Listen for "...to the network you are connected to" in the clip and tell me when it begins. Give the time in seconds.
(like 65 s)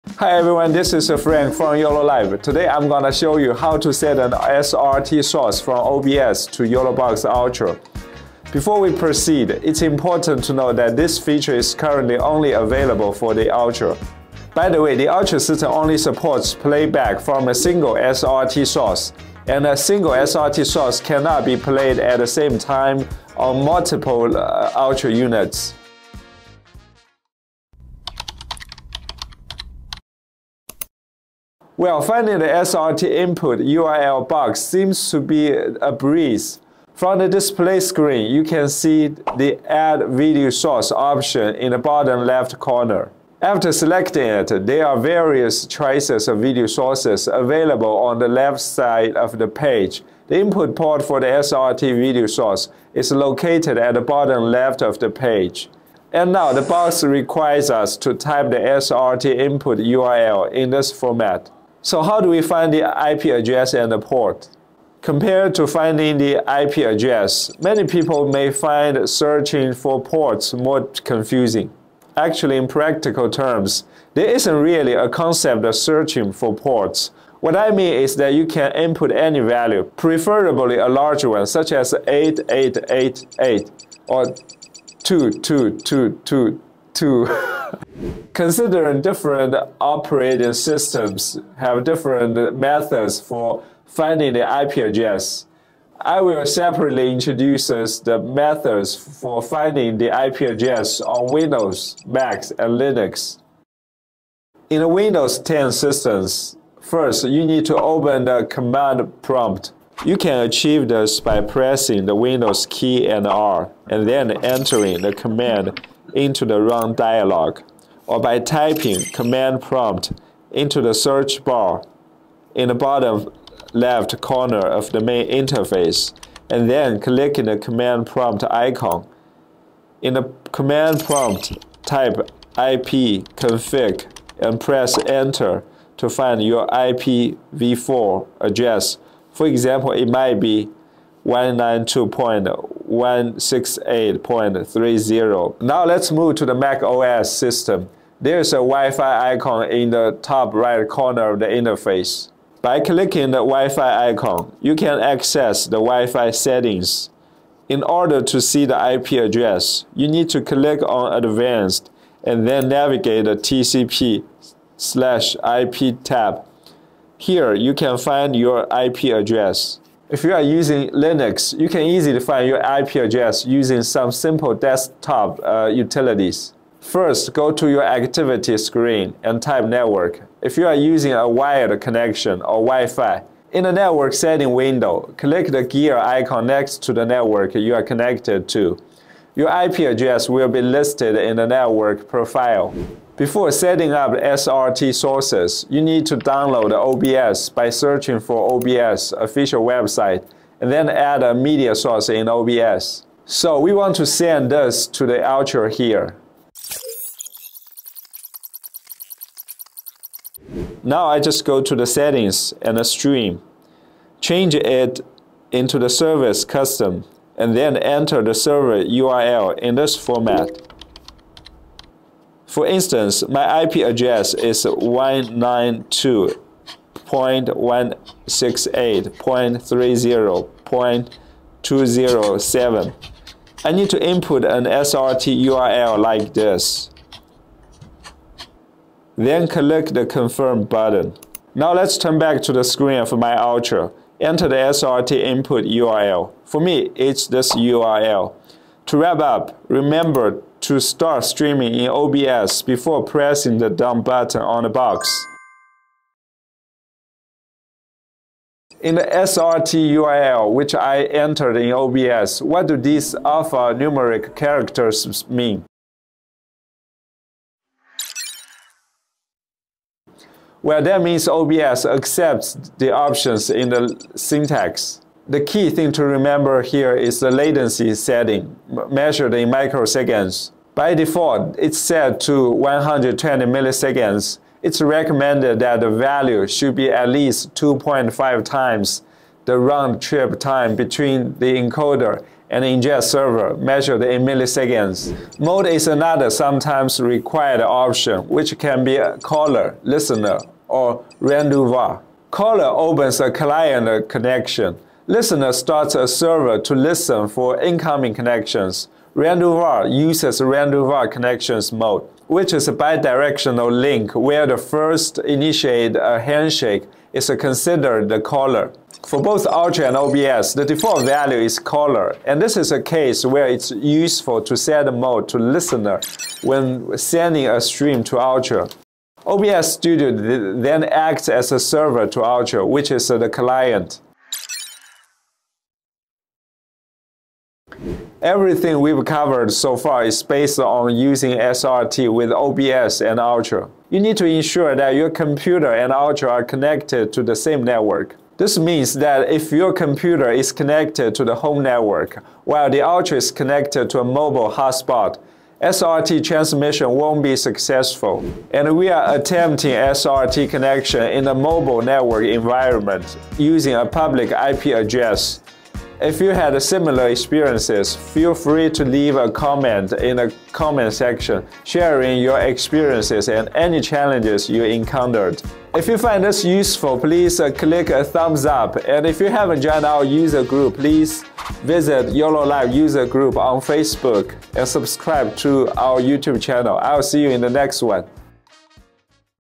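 186 s.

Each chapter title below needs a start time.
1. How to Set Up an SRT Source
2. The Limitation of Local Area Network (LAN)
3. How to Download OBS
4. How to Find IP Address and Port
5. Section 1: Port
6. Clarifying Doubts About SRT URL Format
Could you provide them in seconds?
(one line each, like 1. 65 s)
1. 208 s
2. 336 s
3. 193 s
4. 31 s
5. 65 s
6. 259 s.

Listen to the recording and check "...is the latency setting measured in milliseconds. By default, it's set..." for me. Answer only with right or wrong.
wrong.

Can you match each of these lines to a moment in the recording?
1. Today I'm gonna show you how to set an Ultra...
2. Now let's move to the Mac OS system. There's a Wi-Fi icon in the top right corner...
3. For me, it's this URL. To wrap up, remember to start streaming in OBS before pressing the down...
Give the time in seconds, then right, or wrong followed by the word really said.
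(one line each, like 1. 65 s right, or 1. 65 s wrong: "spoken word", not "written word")
1. 2 s wrong: "SRT", not "Ultra"
2. 145 s right
3. 246 s right.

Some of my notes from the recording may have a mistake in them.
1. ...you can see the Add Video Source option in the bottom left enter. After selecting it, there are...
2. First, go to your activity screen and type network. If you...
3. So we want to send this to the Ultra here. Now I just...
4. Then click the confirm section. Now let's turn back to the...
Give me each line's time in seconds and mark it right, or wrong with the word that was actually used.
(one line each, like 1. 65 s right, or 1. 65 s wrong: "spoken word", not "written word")
1. 38 s wrong: "corner", not "enter"
2. 176 s right
3. 203 s right
4. 239 s wrong: "button", not "section".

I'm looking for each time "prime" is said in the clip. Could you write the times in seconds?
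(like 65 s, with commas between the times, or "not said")
not said.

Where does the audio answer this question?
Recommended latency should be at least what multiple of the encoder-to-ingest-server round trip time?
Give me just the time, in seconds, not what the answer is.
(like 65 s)
287 s.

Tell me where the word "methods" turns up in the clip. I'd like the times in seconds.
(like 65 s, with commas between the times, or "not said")
92 s, 98 s.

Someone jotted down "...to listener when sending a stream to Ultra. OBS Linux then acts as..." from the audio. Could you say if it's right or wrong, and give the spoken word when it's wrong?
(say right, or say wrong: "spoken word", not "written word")
wrong: "Studio", not "Linux".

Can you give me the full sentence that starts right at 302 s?
Caller opens a client connection Listener starts a server to listen for incoming connections.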